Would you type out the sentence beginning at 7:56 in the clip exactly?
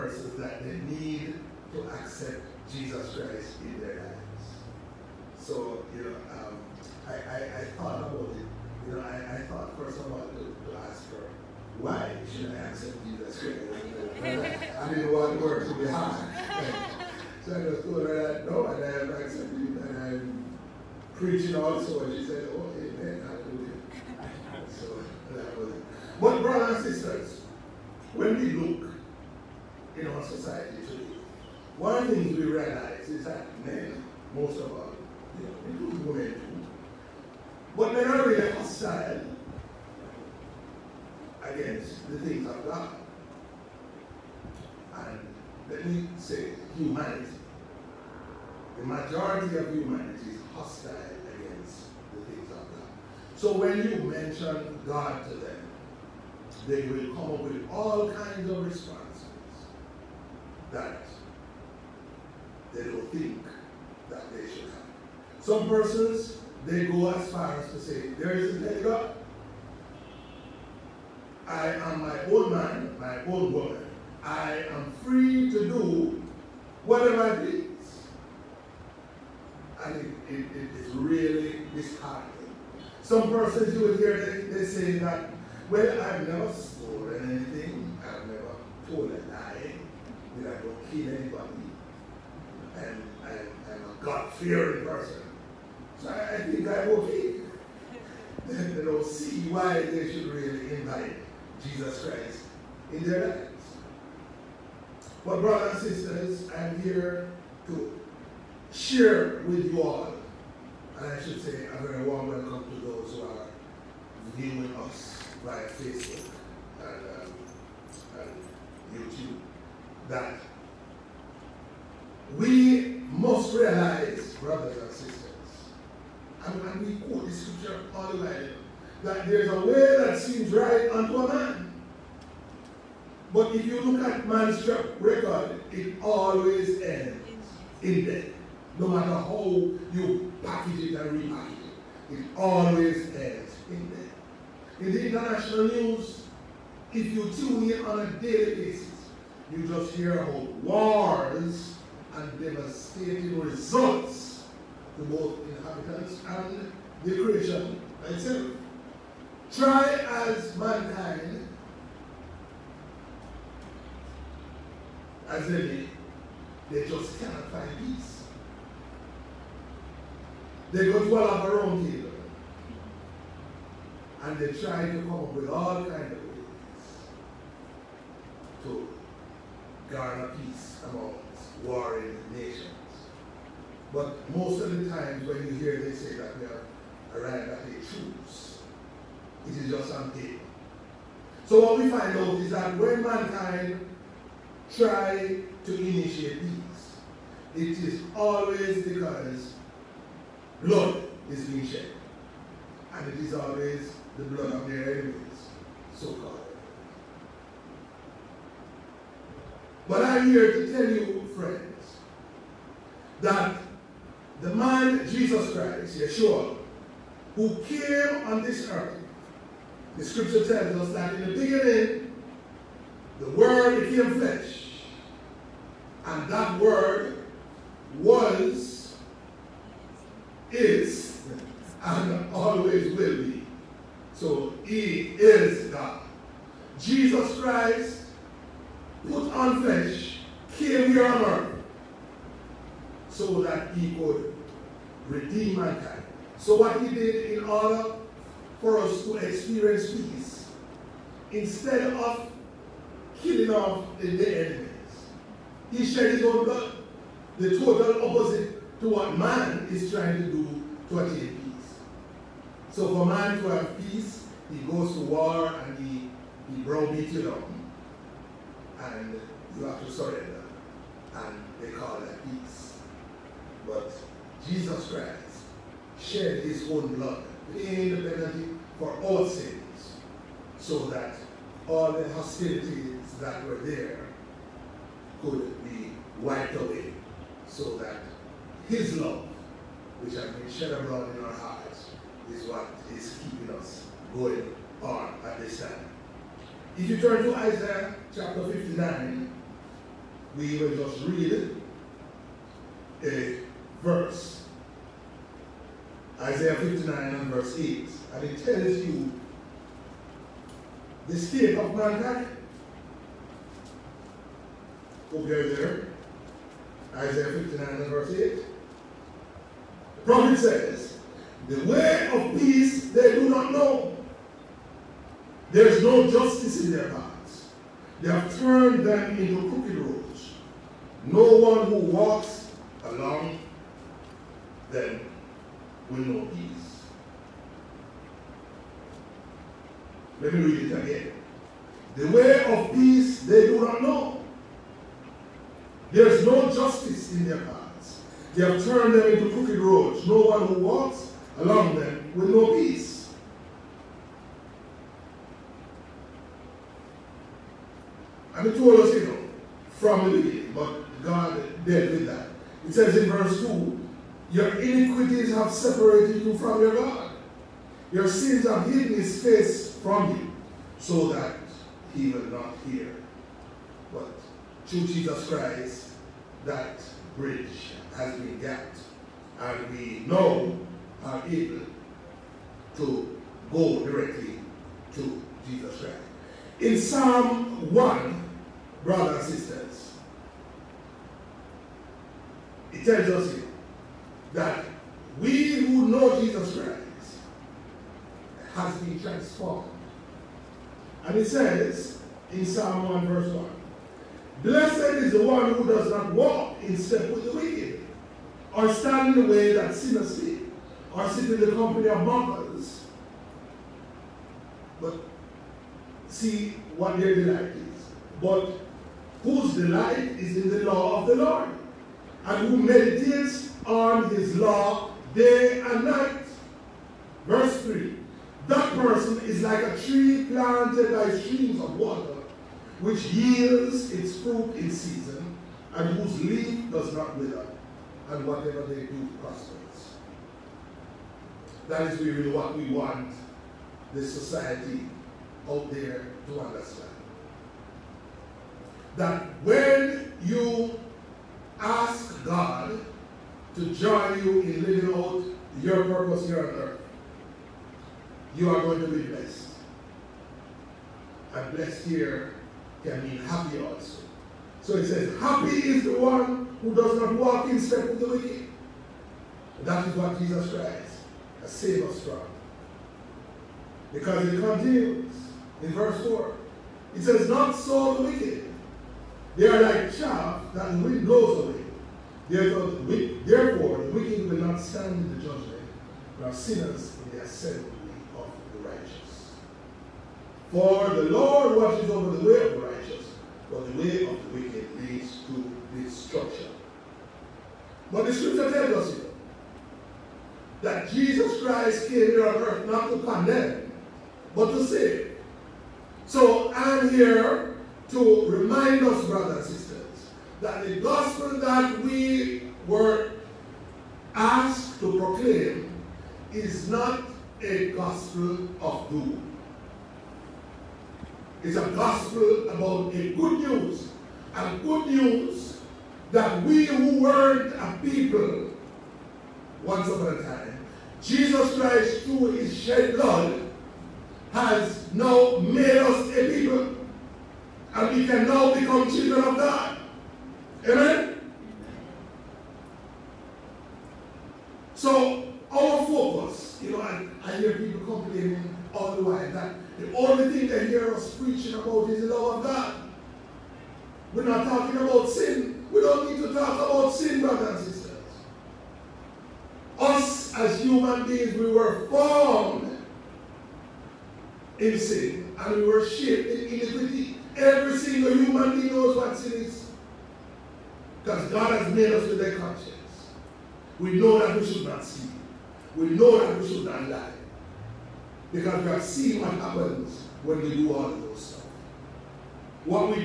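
It says, not so the wicked, they are like chaff that the wind blows away.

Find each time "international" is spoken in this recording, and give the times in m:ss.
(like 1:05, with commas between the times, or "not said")
2:25.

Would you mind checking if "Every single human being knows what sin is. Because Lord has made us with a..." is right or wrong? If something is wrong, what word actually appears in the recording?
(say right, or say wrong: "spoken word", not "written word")
wrong: "God", not "Lord".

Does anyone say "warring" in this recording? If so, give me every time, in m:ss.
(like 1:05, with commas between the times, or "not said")
3:01.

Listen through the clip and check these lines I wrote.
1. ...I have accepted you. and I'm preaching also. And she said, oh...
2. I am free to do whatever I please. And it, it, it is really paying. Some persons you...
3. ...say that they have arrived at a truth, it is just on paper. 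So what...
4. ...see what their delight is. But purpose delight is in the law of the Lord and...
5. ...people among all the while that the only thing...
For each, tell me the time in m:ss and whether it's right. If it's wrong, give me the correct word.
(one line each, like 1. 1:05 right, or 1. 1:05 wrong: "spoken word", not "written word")
1. 0:18 right
2. 1:14 wrong: "disheartening", not "paying"
3. 3:05 right
4. 6:56 wrong: "whose", not "purpose"
5. 9:07 wrong: "complaining", not "among".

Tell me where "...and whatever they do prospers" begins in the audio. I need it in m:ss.
7:18.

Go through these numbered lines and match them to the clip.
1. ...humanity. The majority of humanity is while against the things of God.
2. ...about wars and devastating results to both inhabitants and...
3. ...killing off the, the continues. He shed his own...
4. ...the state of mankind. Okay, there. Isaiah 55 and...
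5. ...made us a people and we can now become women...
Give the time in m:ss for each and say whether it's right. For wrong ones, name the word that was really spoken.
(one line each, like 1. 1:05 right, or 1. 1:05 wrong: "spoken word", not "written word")
1. 0:46 wrong: "hostile", not "while"
2. 2:30 right
3. 4:13 wrong: "enemies", not "continues"
4. 5:11 wrong: "59", not "55"
5. 8:55 wrong: "children", not "women".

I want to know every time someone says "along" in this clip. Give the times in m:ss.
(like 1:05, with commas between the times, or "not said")
5:32, 5:51.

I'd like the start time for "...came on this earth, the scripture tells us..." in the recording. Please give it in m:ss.
3:37.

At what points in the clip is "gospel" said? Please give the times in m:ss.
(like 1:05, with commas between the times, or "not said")
8:30, 8:37, 8:41.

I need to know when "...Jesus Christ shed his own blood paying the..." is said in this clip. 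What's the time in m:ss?
4:34.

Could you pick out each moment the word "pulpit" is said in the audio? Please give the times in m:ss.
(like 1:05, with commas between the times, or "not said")
not said.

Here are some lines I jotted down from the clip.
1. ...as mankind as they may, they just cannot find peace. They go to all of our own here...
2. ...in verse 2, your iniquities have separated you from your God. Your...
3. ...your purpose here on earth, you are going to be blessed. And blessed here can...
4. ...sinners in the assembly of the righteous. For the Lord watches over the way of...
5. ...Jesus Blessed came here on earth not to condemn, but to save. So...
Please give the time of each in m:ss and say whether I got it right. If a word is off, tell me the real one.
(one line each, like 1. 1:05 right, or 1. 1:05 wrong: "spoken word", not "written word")
1. 2:40 right
2. 6:02 right
3. 7:35 right
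4. 8:06 right
5. 8:20 wrong: "Christ", not "Blessed".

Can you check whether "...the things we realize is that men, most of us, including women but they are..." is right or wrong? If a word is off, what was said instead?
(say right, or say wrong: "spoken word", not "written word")
right.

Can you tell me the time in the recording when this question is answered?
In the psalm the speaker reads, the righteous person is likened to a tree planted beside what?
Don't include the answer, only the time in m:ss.
7:11.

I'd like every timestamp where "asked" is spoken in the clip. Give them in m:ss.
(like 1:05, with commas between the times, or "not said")
8:34.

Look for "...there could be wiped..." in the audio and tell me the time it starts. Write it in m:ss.
4:43.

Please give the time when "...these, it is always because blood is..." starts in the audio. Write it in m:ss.
3:16.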